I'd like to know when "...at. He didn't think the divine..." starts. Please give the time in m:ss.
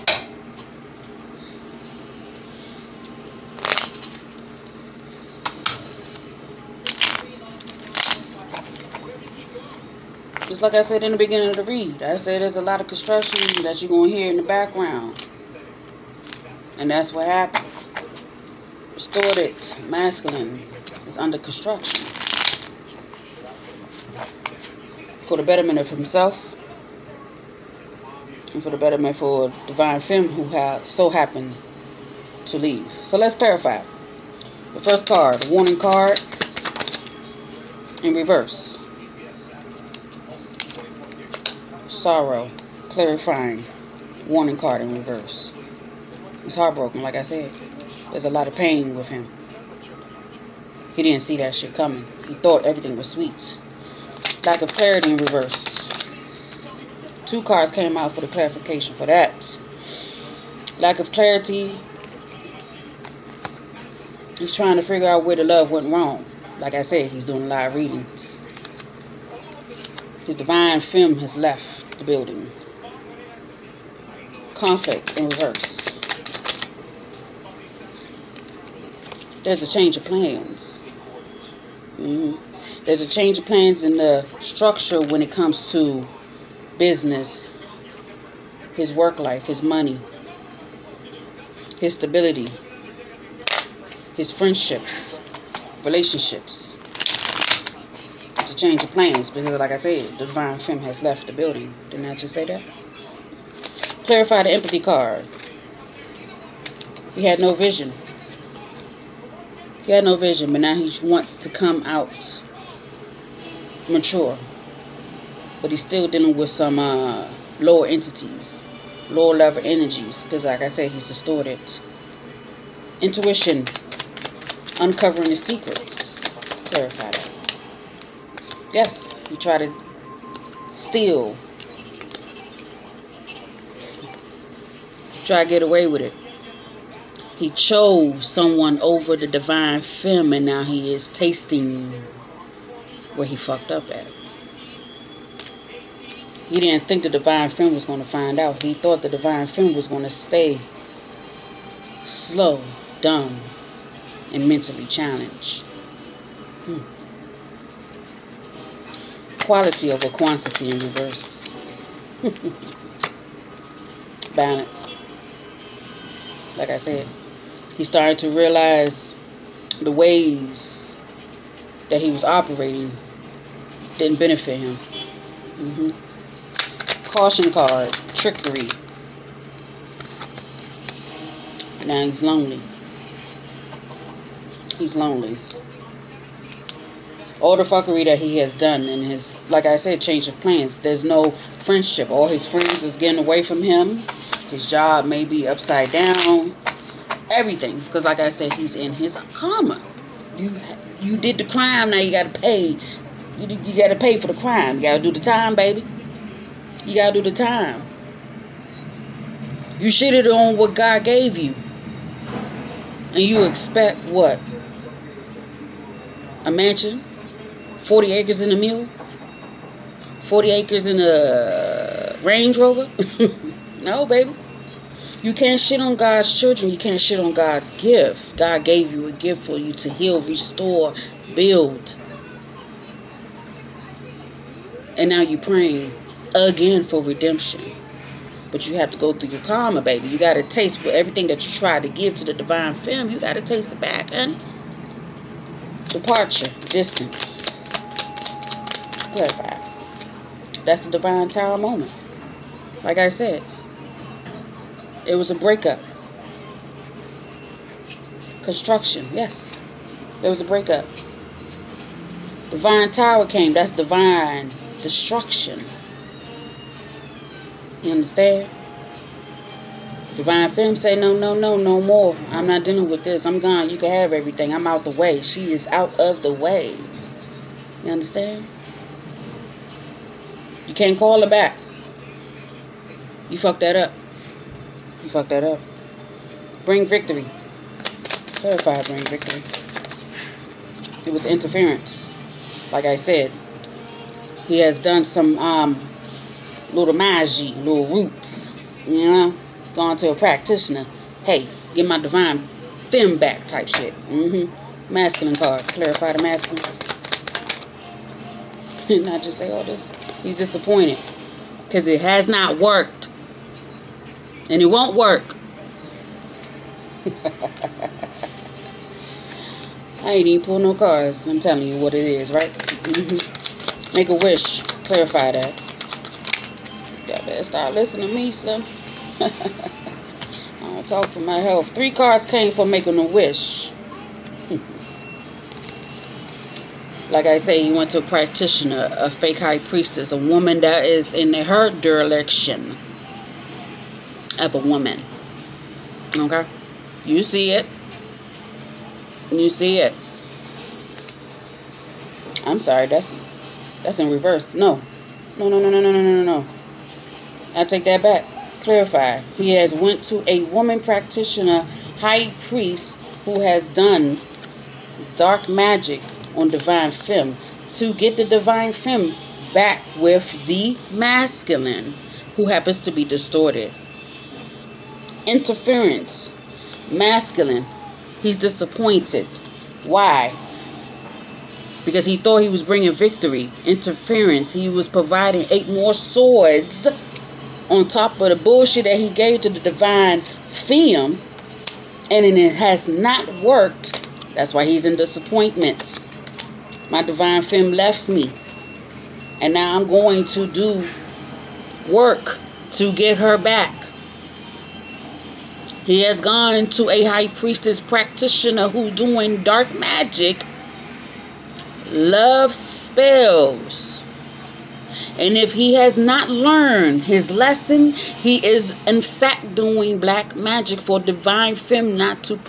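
2:23.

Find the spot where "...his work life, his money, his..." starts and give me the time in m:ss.
1:28.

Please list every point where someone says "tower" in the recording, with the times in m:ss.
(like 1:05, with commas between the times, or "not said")
4:11, 4:22.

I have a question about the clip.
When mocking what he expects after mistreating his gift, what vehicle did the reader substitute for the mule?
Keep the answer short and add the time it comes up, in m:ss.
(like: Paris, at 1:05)
Range Rover, at 3:42.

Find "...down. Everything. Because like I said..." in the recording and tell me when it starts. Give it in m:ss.
3:15.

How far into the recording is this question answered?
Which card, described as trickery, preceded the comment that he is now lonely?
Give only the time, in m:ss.
2:57.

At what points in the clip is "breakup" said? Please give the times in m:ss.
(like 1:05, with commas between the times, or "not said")
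4:15, 4:20.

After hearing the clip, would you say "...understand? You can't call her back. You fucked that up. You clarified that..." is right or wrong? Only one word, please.
wrong.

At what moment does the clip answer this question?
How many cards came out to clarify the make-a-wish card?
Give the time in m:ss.
5:31.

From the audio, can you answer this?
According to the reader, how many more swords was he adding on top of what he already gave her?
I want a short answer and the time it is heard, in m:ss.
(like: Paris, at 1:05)
8, at 6:25.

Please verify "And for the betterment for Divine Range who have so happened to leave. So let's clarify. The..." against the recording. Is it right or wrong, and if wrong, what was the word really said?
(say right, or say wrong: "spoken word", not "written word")
wrong: "Femme", not "Range".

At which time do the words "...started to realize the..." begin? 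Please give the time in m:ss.
2:47.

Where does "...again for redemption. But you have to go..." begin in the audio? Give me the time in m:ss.
3:56.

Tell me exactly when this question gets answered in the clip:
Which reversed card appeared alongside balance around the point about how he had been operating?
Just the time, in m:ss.
2:39.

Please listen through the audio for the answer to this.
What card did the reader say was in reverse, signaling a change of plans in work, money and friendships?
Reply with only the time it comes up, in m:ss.
1:14.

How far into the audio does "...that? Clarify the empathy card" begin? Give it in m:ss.
1:42.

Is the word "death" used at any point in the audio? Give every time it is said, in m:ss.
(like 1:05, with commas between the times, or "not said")
not said.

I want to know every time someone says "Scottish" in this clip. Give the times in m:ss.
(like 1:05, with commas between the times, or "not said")
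not said.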